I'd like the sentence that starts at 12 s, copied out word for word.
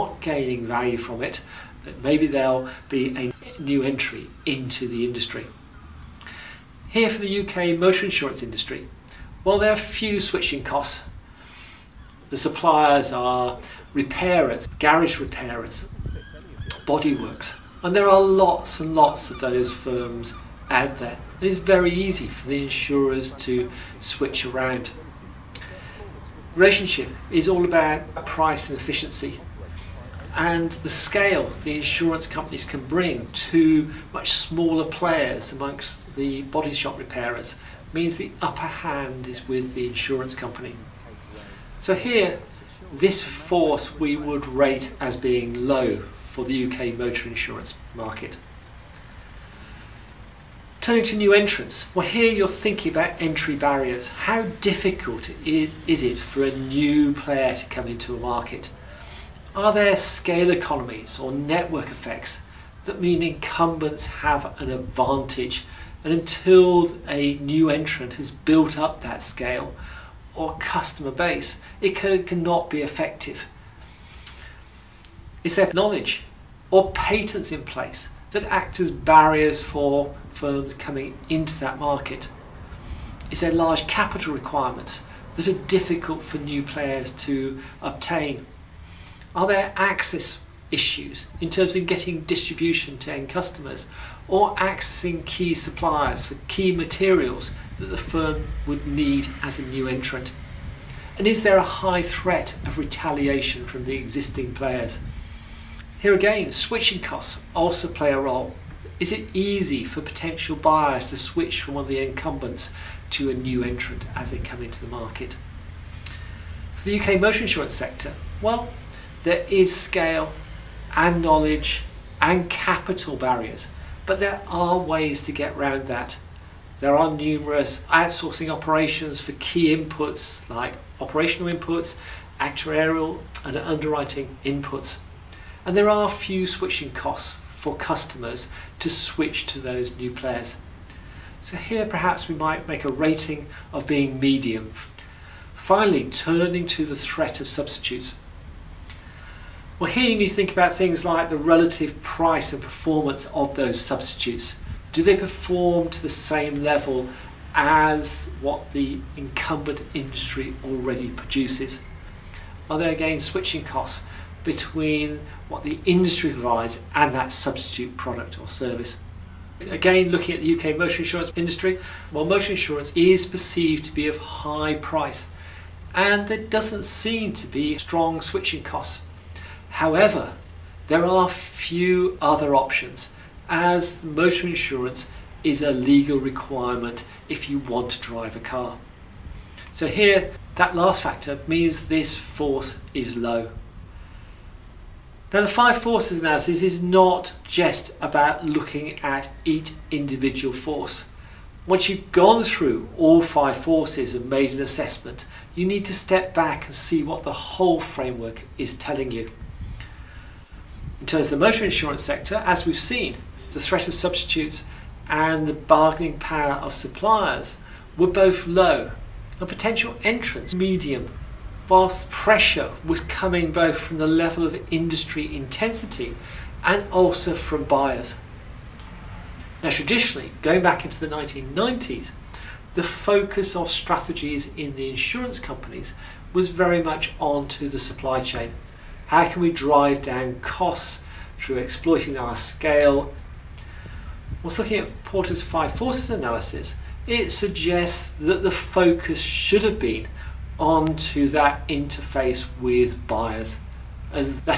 The suppliers are repairers, garage repairers, bodyworks, and there are lots and lots of those firms out there.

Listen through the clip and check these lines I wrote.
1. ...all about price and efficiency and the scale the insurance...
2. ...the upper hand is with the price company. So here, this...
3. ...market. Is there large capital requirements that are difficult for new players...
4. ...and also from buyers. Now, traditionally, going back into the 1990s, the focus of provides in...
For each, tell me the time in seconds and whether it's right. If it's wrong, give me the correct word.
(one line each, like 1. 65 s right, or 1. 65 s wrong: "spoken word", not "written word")
1. 27 s right
2. 38 s wrong: "insurance", not "price"
3. 81 s right
4. 226 s wrong: "strategies", not "provides".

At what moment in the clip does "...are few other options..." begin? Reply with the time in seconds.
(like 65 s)
181 s.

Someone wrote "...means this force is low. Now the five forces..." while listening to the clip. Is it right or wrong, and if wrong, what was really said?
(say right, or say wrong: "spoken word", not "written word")
right.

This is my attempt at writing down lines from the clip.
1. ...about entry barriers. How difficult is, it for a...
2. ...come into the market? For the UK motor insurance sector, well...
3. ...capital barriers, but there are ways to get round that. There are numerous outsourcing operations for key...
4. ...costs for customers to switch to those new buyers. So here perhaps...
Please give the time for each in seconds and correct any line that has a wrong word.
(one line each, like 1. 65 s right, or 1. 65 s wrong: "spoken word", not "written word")
1. 52 s right
2. 114 s right
3. 122 s right
4. 136 s wrong: "players", not "buyers".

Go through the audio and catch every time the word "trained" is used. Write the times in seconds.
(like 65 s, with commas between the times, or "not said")
not said.